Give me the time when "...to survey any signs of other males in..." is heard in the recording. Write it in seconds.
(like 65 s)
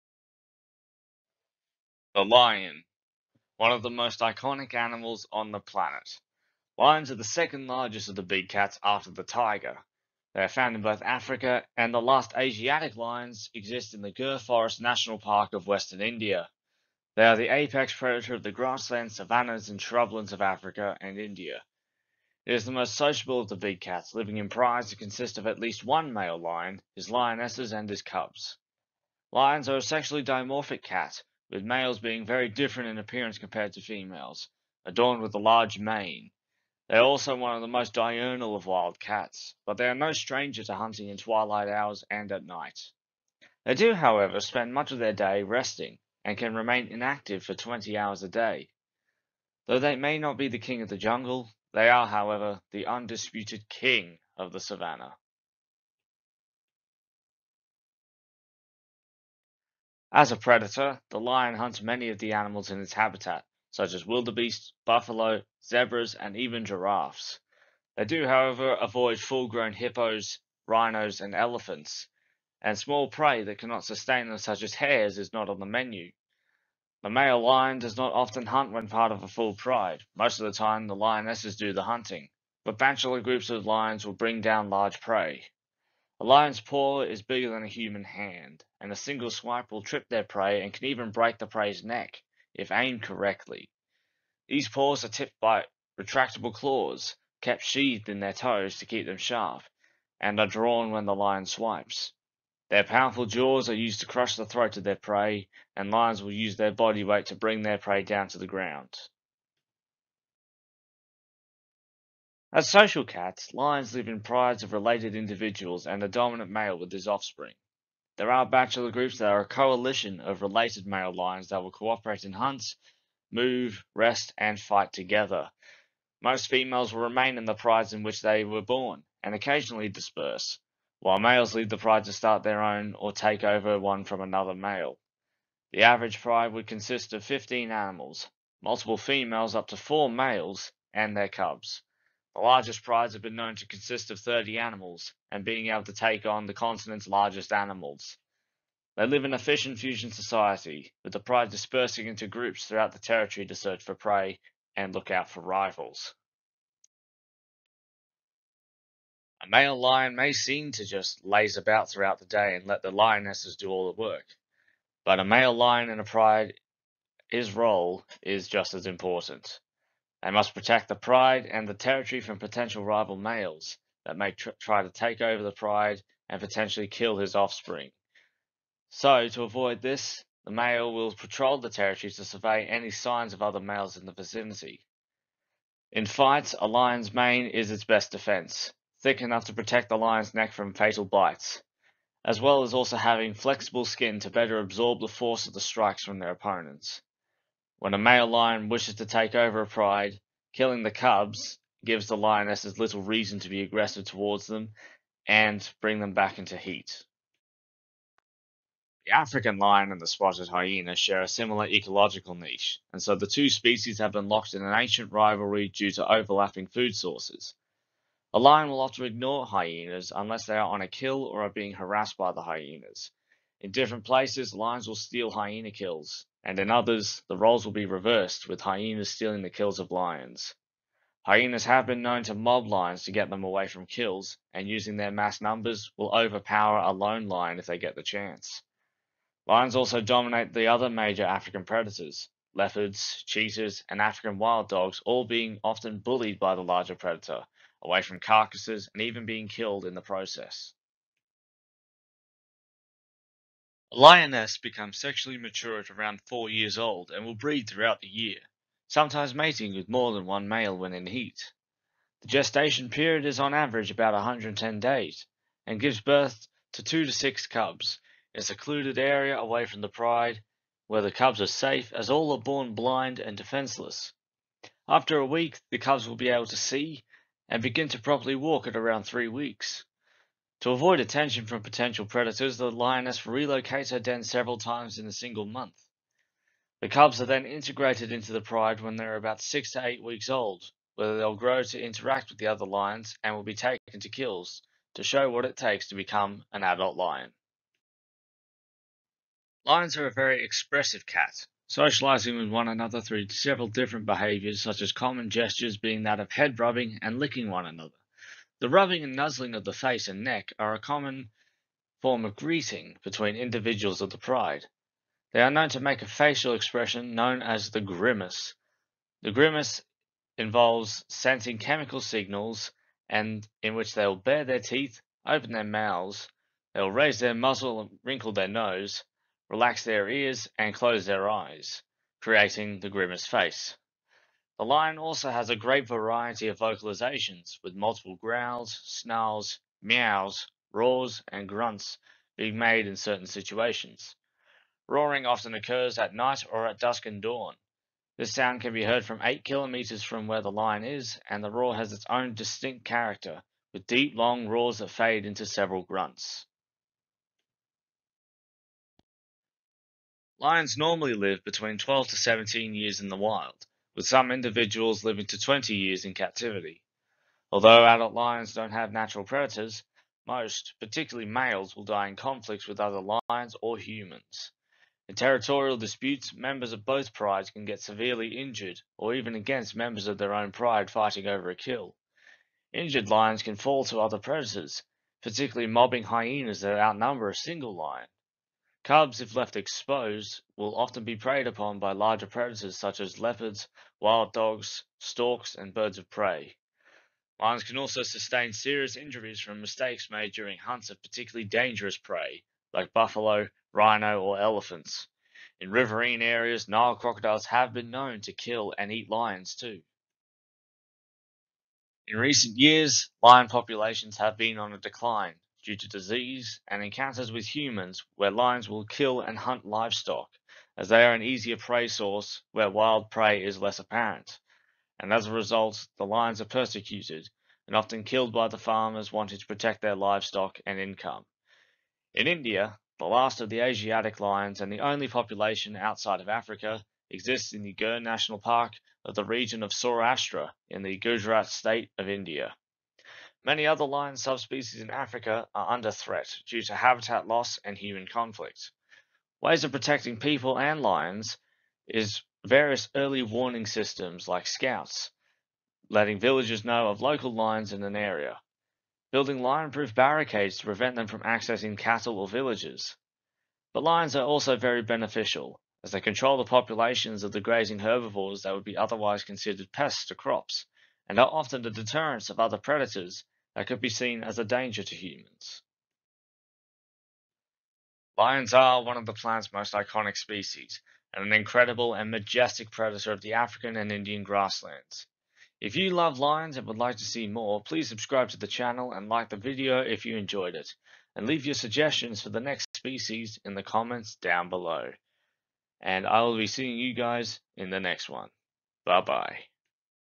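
182 s.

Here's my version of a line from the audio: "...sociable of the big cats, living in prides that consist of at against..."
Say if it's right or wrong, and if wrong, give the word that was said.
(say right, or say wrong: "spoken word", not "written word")
wrong: "least", not "against".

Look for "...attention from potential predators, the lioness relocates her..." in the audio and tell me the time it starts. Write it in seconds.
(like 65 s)
280 s.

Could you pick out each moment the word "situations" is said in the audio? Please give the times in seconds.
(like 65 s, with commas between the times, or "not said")
343 s.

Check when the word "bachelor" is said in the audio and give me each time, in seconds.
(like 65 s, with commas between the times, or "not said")
82 s, 118 s.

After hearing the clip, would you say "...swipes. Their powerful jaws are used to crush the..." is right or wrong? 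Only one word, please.
right.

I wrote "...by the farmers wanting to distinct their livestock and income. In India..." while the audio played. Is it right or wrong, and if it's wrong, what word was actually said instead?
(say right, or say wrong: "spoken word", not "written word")
wrong: "protect", not "distinct".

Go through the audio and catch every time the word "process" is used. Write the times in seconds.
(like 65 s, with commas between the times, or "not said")
250 s.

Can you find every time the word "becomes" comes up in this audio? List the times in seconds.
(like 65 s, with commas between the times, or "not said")
254 s, 295 s.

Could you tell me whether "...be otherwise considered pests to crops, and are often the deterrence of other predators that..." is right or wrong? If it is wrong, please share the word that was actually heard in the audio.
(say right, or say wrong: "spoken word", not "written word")
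right.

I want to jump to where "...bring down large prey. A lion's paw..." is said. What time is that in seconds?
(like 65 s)
84 s.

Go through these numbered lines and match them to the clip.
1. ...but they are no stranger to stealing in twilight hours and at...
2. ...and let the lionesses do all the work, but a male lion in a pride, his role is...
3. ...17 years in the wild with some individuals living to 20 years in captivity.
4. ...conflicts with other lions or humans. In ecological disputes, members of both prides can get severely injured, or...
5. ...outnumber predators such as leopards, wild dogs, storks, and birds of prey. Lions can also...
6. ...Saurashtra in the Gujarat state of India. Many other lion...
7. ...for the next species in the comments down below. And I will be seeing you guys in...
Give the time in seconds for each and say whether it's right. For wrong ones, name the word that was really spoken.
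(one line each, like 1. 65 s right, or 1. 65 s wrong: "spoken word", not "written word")
1. 39 s wrong: "hunting", not "stealing"
2. 162 s right
3. 362 s right
4. 372 s wrong: "territorial", not "ecological"
5. 391 s wrong: "larger", not "outnumber"
6. 439 s right
7. 492 s right.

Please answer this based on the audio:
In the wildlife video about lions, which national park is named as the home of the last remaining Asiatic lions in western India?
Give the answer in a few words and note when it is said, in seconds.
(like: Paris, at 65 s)
Gir Forest National Park, at 14 s.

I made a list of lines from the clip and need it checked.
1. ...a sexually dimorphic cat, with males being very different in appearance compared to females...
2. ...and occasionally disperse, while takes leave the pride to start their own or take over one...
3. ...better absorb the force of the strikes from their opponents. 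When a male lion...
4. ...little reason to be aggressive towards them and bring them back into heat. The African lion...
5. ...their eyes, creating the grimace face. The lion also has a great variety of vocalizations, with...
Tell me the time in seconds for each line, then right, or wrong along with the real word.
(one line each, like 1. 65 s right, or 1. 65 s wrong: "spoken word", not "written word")
1. 29 s right
2. 129 s wrong: "males", not "takes"
3. 194 s right
4. 202 s right
5. 331 s right.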